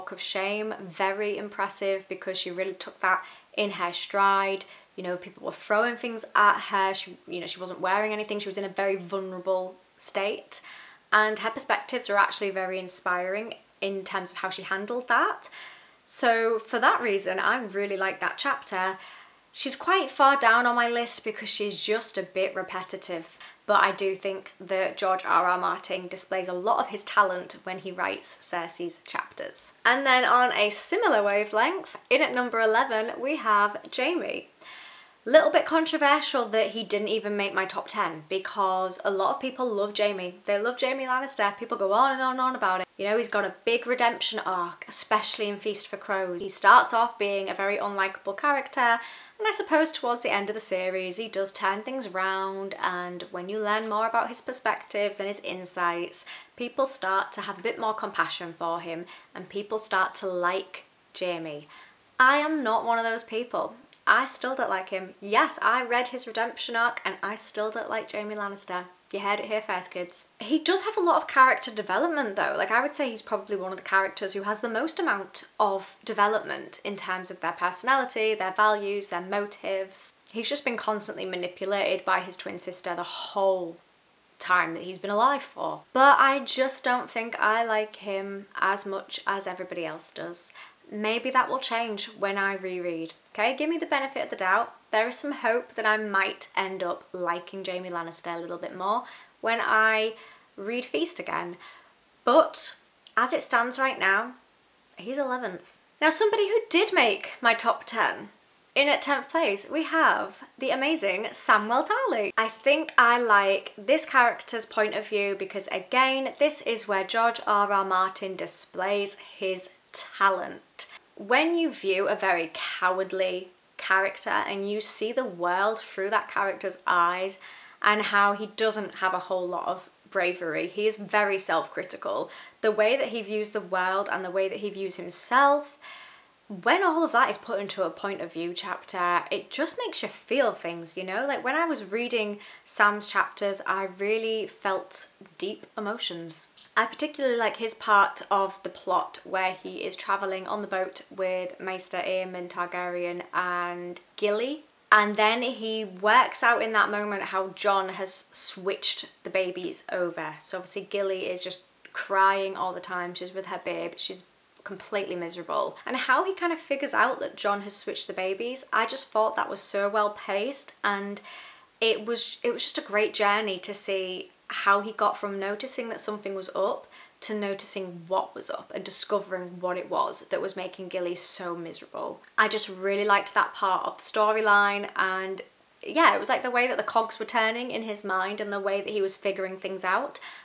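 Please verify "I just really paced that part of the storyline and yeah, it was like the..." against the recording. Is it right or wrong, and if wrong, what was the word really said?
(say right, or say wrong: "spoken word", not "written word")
wrong: "liked", not "paced".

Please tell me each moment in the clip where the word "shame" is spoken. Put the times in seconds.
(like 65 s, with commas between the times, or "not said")
0 s.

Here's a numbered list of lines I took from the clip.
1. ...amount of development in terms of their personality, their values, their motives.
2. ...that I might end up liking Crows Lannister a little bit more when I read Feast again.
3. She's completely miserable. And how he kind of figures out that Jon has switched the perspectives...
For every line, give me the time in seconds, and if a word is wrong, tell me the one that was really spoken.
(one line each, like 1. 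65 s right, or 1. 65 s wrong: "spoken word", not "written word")
1. 74 s right
2. 95 s wrong: "Jaime", not "Crows"
3. 163 s wrong: "babies", not "perspectives".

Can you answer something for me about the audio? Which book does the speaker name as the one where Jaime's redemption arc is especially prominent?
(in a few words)
Feast for Crows.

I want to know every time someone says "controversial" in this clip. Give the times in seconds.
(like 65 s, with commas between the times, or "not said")
35 s.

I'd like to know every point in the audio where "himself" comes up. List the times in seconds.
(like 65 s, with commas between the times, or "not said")
134 s.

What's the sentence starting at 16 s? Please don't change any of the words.
So for that reason, I really like that chapter.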